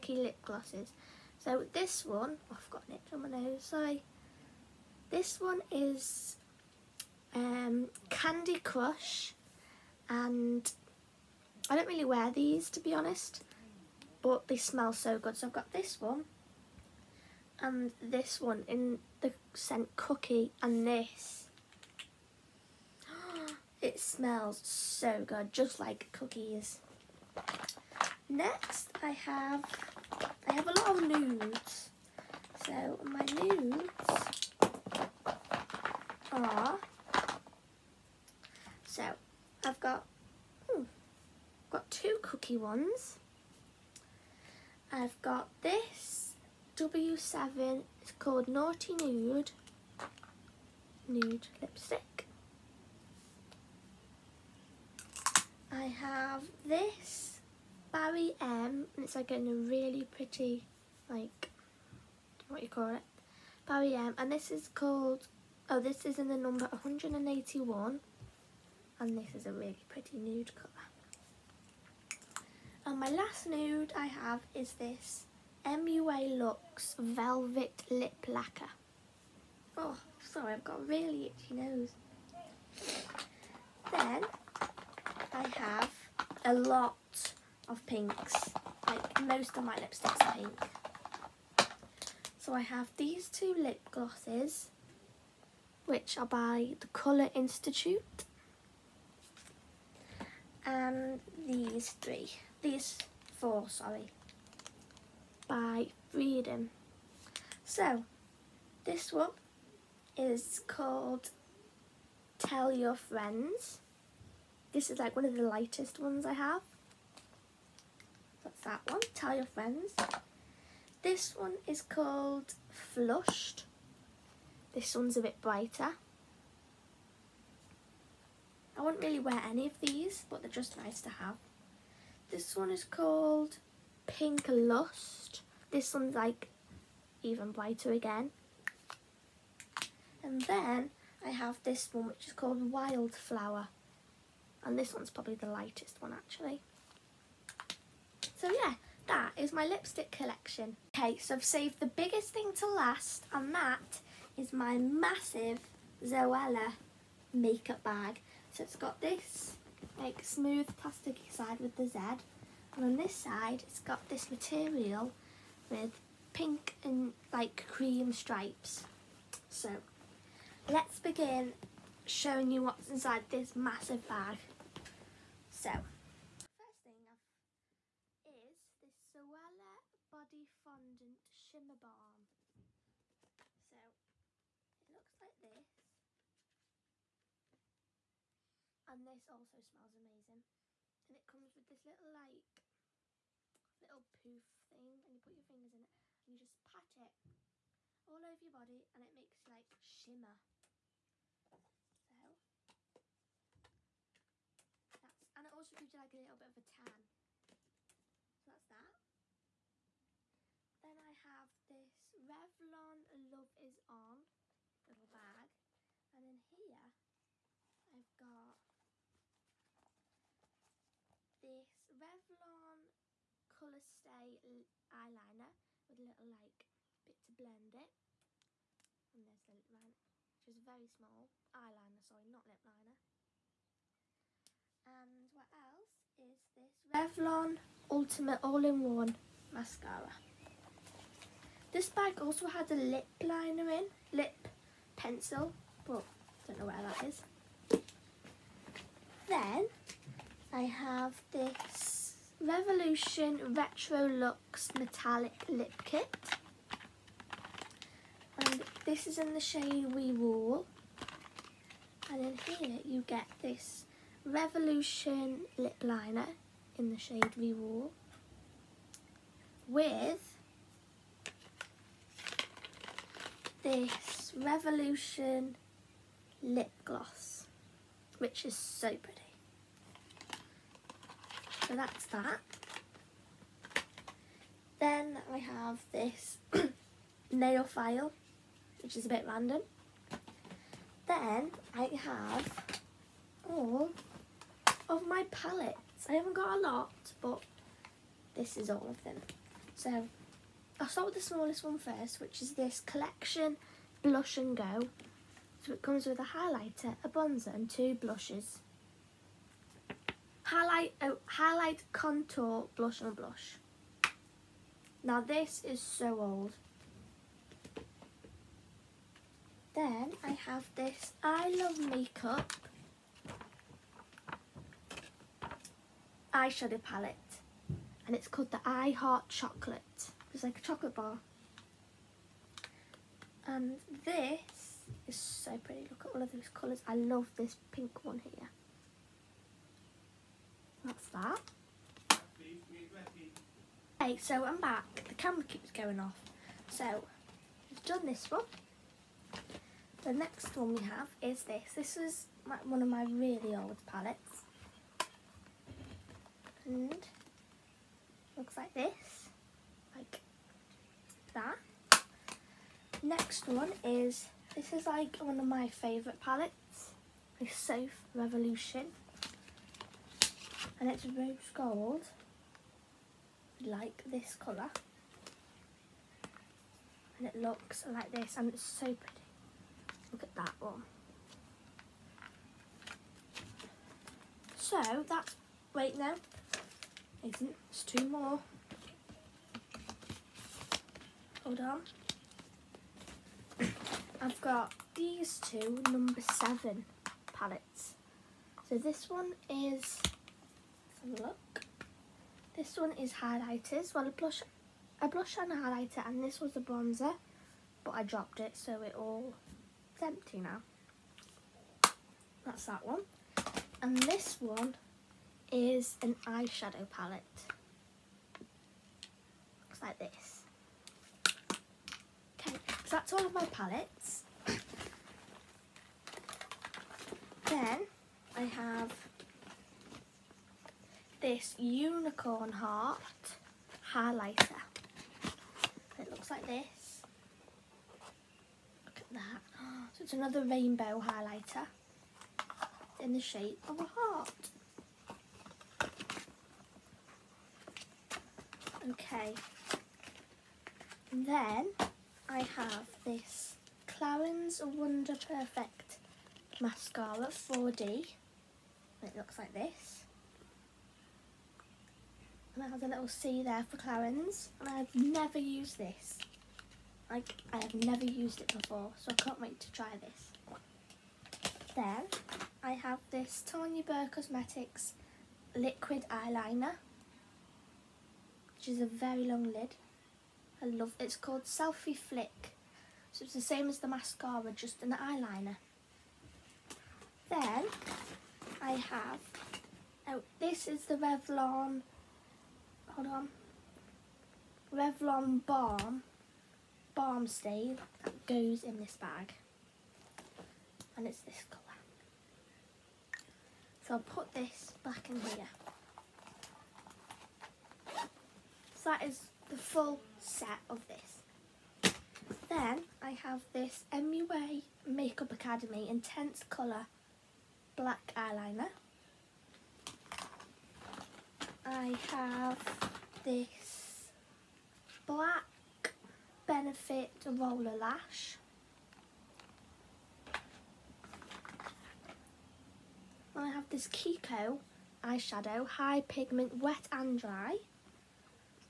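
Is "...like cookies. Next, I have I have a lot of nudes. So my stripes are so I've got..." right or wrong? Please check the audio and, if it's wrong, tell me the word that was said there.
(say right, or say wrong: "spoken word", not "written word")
wrong: "nudes", not "stripes".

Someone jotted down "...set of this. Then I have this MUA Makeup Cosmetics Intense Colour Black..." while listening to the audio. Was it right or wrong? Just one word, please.
wrong.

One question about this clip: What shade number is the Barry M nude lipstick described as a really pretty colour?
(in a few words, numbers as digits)
181.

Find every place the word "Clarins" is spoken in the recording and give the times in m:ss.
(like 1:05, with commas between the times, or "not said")
7:33, 7:43.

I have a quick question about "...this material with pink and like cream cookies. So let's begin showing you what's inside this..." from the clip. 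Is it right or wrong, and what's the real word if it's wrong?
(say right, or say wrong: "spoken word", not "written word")
wrong: "stripes", not "cookies".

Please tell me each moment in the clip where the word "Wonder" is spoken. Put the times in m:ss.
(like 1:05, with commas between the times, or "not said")
7:34.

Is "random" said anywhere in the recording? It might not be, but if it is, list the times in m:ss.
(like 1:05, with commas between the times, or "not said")
4:49.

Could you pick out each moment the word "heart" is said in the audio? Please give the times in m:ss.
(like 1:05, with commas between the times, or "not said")
5:28, 7:12, 7:23.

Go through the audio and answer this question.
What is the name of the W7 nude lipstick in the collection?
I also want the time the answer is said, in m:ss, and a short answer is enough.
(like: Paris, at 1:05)
Naughty Nude, at 0:48.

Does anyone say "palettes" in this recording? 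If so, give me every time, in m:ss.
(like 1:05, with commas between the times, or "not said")
4:55, 5:26, 5:53, 6:06, 6:37, 6:56, 7:03.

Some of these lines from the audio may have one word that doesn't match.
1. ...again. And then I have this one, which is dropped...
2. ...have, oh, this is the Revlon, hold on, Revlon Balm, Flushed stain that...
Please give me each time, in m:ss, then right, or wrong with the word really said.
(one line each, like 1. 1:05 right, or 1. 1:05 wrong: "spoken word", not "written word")
1. 2:17 wrong: "called", not "dropped"
2. 8:08 wrong: "Balm", not "Flushed".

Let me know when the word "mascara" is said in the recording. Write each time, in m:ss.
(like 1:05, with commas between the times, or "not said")
3:59, 7:36, 8:03.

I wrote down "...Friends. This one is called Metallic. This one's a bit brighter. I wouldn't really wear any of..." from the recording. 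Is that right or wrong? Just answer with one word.
wrong.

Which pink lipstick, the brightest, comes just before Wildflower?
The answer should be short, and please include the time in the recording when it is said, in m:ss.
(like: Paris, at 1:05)
Pink Lust, at 2:14.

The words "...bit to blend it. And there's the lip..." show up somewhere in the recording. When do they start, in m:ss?
3:47.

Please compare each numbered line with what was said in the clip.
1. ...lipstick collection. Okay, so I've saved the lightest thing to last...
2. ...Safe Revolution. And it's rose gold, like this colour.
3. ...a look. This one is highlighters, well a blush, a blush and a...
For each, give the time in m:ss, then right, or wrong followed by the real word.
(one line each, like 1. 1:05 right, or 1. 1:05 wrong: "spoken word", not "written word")
1. 2:29 wrong: "biggest", not "lightest"
2. 6:07 right
3. 6:41 right.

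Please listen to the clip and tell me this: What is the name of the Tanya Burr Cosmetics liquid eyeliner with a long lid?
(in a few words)
Selfie Flick.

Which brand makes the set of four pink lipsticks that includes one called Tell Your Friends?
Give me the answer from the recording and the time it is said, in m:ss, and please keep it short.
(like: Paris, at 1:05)
Freedom, at 1:46.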